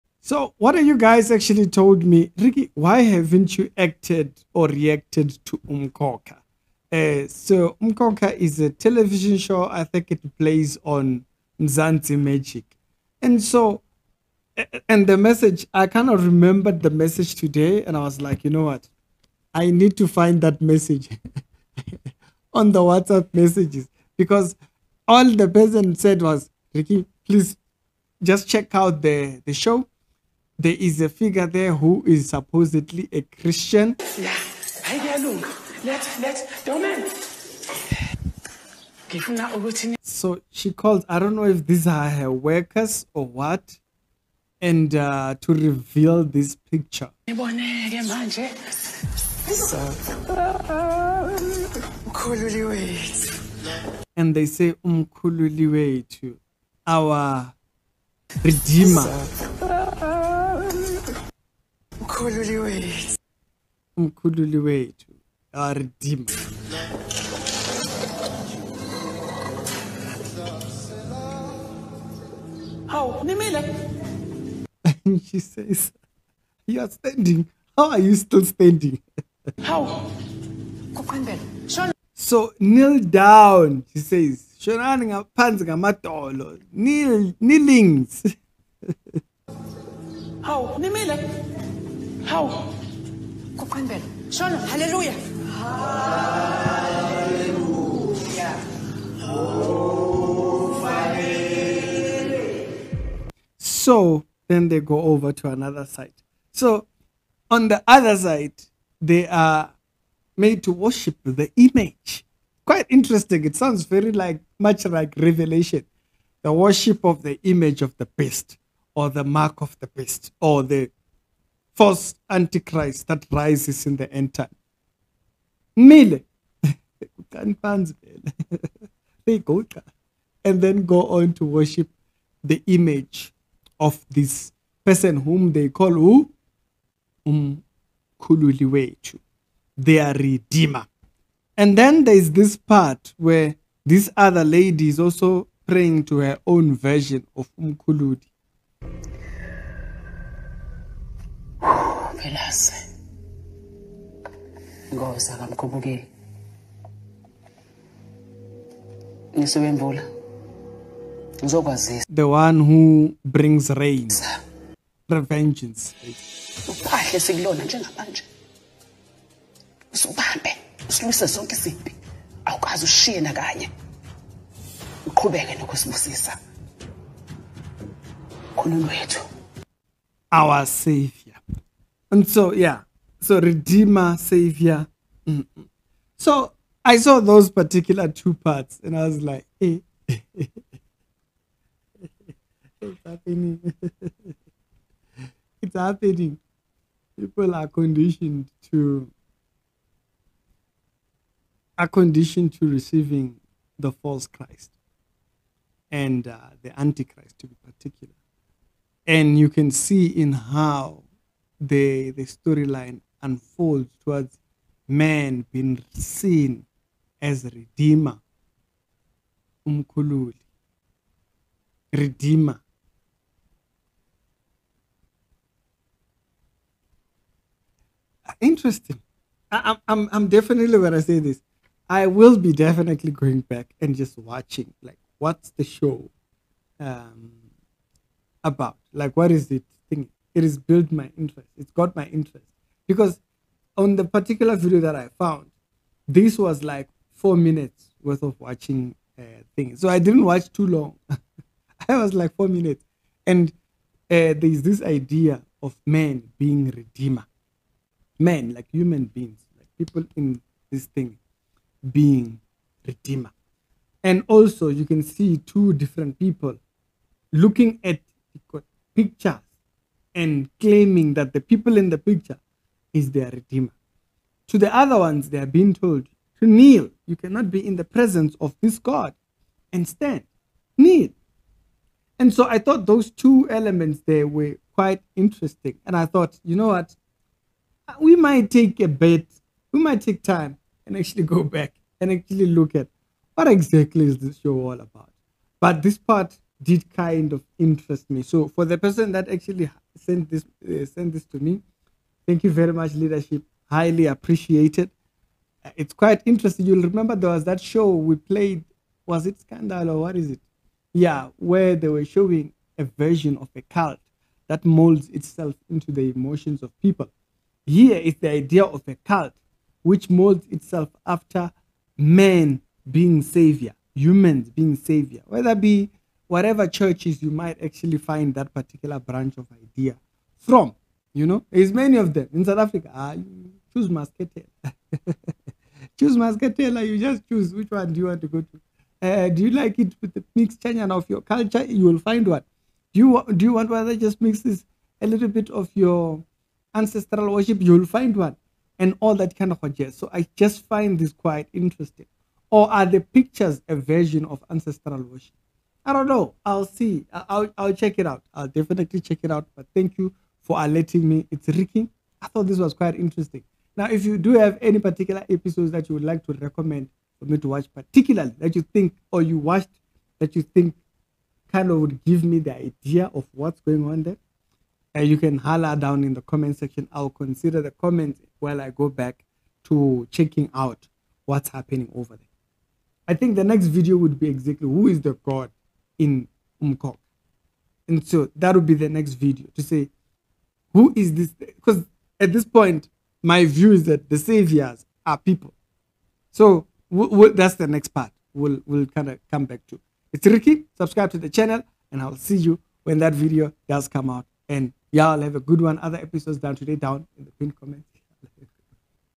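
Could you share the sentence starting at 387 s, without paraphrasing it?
And so that will be the next video to say, who is this?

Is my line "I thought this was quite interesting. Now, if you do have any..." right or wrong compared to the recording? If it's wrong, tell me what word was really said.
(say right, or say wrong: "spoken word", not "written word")
right.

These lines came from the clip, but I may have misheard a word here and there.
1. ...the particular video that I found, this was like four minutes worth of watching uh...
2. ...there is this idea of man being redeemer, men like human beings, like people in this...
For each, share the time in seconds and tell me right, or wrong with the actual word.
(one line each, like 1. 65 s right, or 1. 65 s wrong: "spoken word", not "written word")
1. 243 s right
2. 254 s right.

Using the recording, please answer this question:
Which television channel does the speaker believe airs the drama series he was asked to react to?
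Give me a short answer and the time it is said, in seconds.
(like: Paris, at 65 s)
Mzansi Magic, at 11 s.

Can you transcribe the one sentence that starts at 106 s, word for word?
So on the other side, they are made to worship the image.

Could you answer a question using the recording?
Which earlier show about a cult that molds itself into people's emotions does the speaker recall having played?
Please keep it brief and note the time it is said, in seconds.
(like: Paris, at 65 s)
Scandal, at 309 s.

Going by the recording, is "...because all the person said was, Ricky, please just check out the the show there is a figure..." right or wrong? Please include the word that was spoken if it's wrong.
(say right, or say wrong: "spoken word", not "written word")
right.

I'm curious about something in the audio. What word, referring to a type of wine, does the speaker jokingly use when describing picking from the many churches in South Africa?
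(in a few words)
Muscatel.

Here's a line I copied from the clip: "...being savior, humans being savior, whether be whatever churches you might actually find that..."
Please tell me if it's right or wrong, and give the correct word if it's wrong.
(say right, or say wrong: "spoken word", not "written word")
right.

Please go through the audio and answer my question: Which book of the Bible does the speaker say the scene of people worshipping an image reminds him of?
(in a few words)
Revelation.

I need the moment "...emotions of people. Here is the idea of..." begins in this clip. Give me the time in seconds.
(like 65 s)
316 s.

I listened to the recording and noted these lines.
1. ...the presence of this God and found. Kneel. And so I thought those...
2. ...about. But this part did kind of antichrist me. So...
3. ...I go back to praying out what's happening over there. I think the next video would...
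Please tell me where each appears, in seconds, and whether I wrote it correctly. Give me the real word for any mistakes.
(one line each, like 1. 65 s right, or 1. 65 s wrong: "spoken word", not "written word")
1. 277 s wrong: "stand", not "found"
2. 294 s wrong: "interest", not "antichrist"
3. 378 s wrong: "checking", not "praying".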